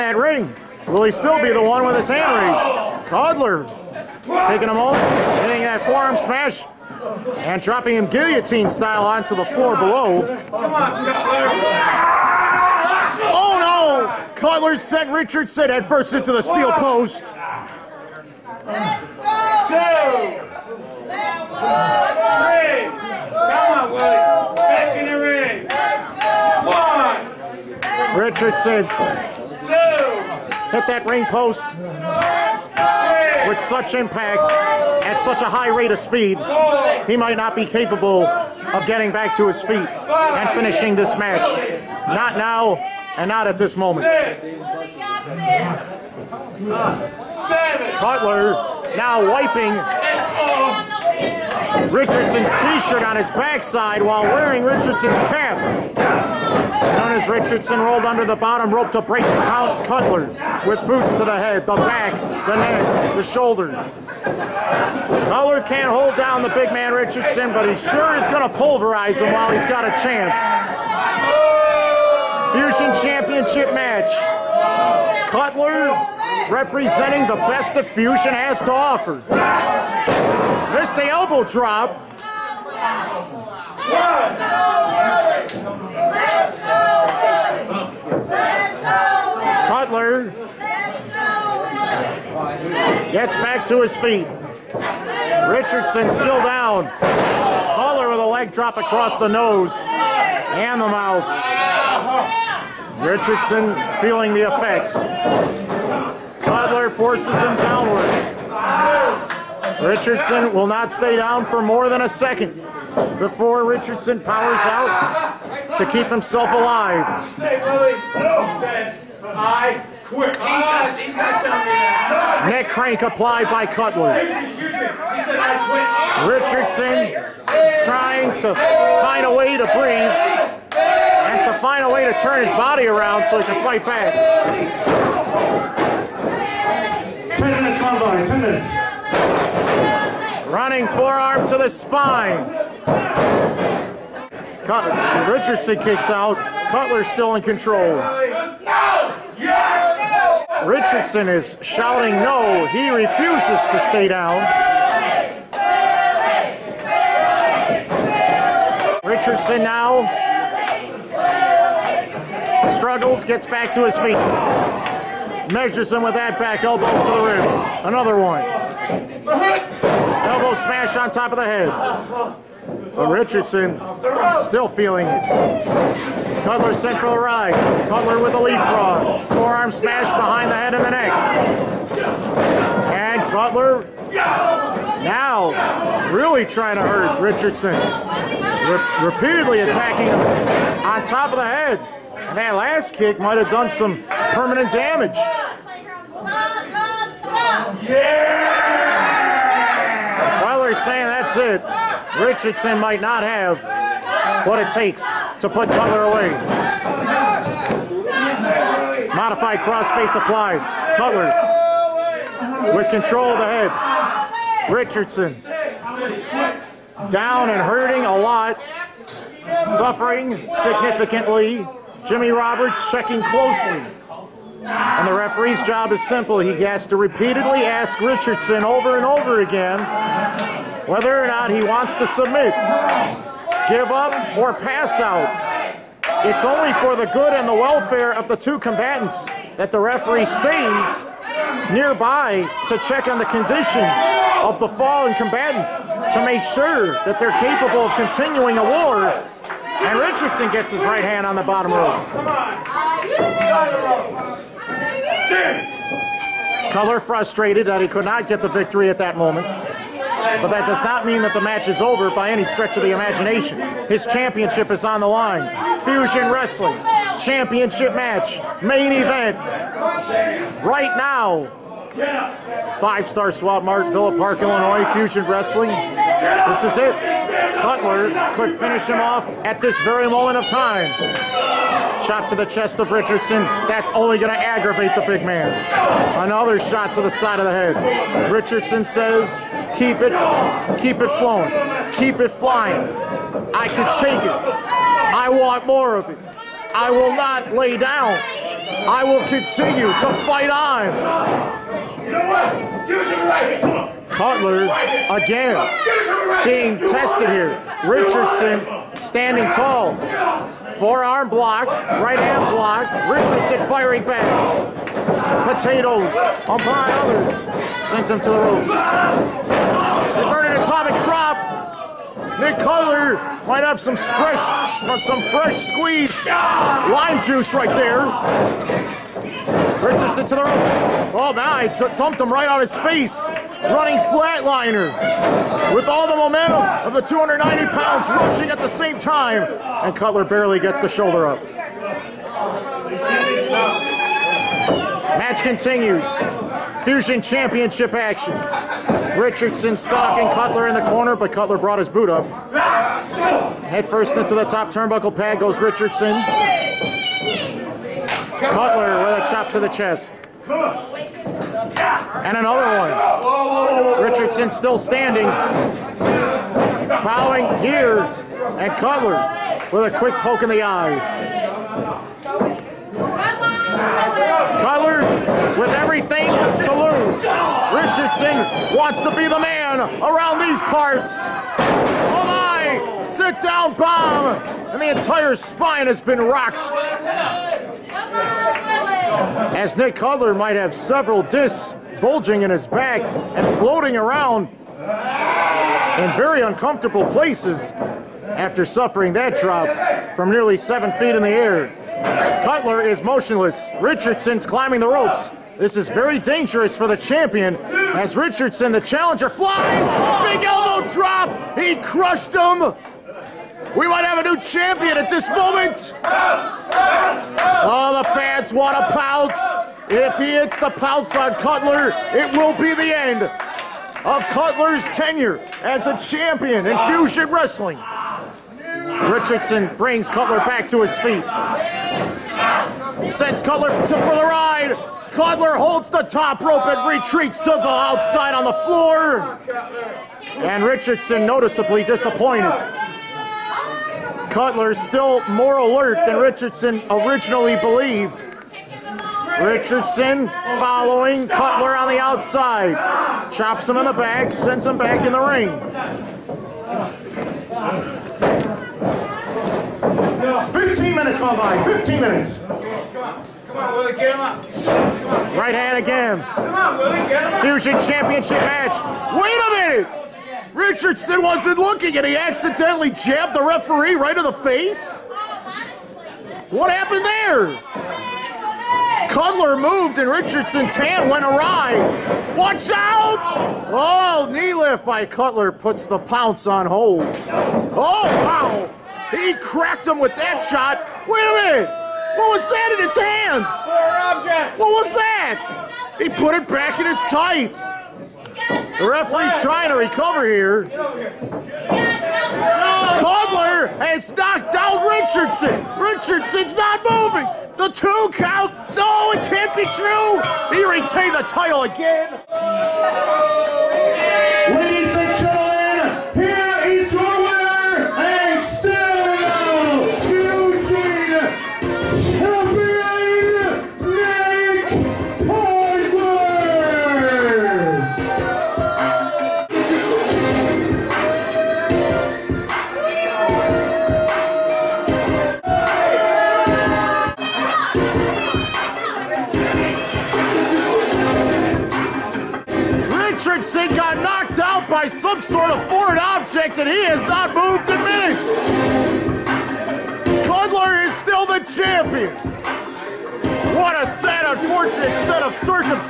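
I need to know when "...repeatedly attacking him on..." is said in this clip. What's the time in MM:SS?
03:09.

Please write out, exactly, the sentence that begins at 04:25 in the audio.
Fusion Wrestling, championship match, main event.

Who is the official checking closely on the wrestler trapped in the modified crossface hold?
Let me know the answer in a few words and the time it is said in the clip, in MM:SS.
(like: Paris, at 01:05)
Jimmy Roberts, at 03:42.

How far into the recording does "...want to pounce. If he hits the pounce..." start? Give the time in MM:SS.
06:58.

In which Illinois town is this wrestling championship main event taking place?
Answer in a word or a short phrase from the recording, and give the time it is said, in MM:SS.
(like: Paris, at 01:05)
Villa Park, at 04:33.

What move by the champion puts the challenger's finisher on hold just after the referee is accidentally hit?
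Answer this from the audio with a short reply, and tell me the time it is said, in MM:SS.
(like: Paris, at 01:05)
Knee lift, at 08:04.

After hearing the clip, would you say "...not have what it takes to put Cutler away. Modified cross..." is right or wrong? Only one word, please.
right.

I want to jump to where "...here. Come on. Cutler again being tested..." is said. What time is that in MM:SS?
05:03.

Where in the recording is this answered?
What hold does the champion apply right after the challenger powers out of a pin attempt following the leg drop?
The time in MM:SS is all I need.
02:02.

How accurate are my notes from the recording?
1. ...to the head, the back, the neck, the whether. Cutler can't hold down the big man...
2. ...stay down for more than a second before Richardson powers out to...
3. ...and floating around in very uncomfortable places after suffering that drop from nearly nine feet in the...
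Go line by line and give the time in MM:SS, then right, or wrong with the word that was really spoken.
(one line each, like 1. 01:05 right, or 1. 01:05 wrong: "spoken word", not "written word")
1. 01:01 wrong: "shoulder", not "whether"
2. 01:50 right
3. 06:33 wrong: "seven", not "nine".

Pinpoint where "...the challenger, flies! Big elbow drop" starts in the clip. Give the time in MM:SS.
06:48.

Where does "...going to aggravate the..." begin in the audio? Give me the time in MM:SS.
04:44.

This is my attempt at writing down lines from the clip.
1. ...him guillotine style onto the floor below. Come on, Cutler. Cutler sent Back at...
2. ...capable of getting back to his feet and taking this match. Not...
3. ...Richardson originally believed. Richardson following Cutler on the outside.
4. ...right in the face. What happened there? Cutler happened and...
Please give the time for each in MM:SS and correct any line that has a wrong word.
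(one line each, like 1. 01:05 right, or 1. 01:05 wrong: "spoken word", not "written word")
1. 00:07 wrong: "Richardson", not "Back"
2. 00:37 wrong: "finishing", not "taking"
3. 07:26 right
4. 07:53 wrong: "moved", not "happened".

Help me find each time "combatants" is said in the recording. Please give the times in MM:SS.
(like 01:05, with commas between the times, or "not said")
03:58, 04:05.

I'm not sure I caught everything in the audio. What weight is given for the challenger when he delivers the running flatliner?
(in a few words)
290 pounds.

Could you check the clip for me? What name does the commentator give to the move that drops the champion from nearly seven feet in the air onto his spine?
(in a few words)
Sit down bomb.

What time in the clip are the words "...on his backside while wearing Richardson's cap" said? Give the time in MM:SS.
00:53.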